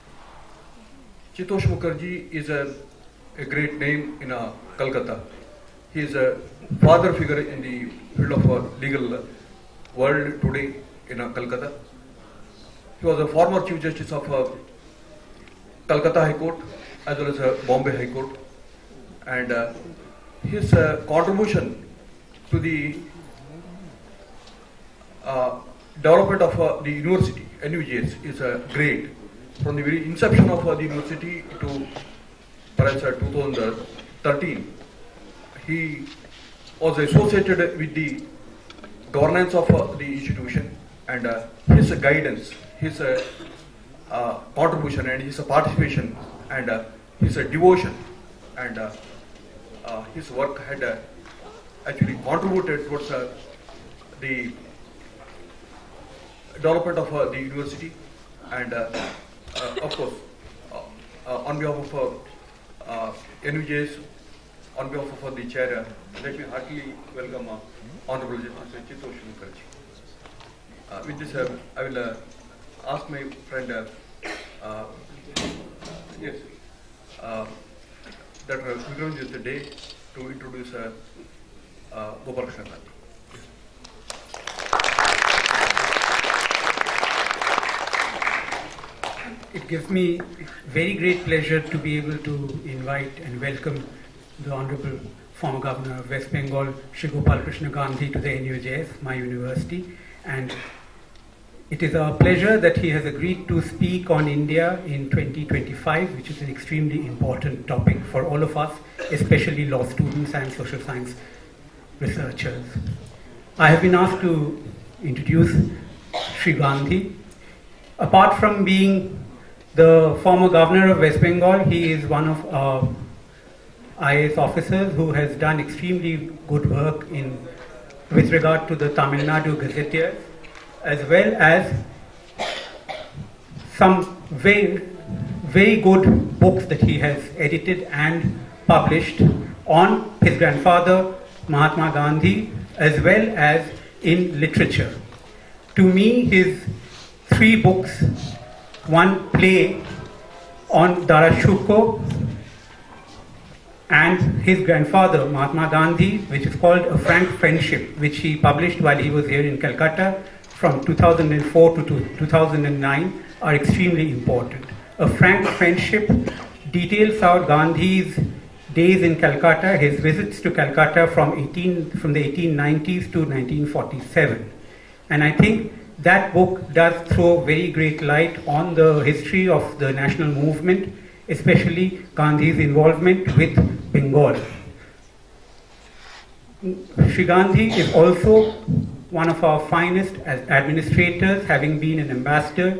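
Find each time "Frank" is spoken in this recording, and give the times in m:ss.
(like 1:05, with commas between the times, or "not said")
2:36, 2:45.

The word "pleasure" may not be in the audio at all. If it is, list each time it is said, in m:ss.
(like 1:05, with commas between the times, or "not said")
1:31, 1:42.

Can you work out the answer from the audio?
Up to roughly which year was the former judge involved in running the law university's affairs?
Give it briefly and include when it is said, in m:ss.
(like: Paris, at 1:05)
2013, at 0:33.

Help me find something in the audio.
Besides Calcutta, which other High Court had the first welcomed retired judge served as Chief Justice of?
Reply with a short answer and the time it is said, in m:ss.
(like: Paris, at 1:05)
Bombay High Court, at 0:17.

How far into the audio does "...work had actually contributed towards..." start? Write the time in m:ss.
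0:50.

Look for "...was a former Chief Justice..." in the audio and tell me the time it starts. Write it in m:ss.
0:13.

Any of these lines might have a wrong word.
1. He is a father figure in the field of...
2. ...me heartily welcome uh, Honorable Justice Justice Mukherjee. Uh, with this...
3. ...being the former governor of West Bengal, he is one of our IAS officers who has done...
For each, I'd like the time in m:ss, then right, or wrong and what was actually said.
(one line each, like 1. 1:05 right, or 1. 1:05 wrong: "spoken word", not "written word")
1. 0:05 right
2. 1:06 wrong: "Chittatosh", not "Justice"
3. 1:58 right.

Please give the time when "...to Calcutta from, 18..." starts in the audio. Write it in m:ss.
2:50.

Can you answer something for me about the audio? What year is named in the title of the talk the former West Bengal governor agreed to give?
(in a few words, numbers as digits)
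2025.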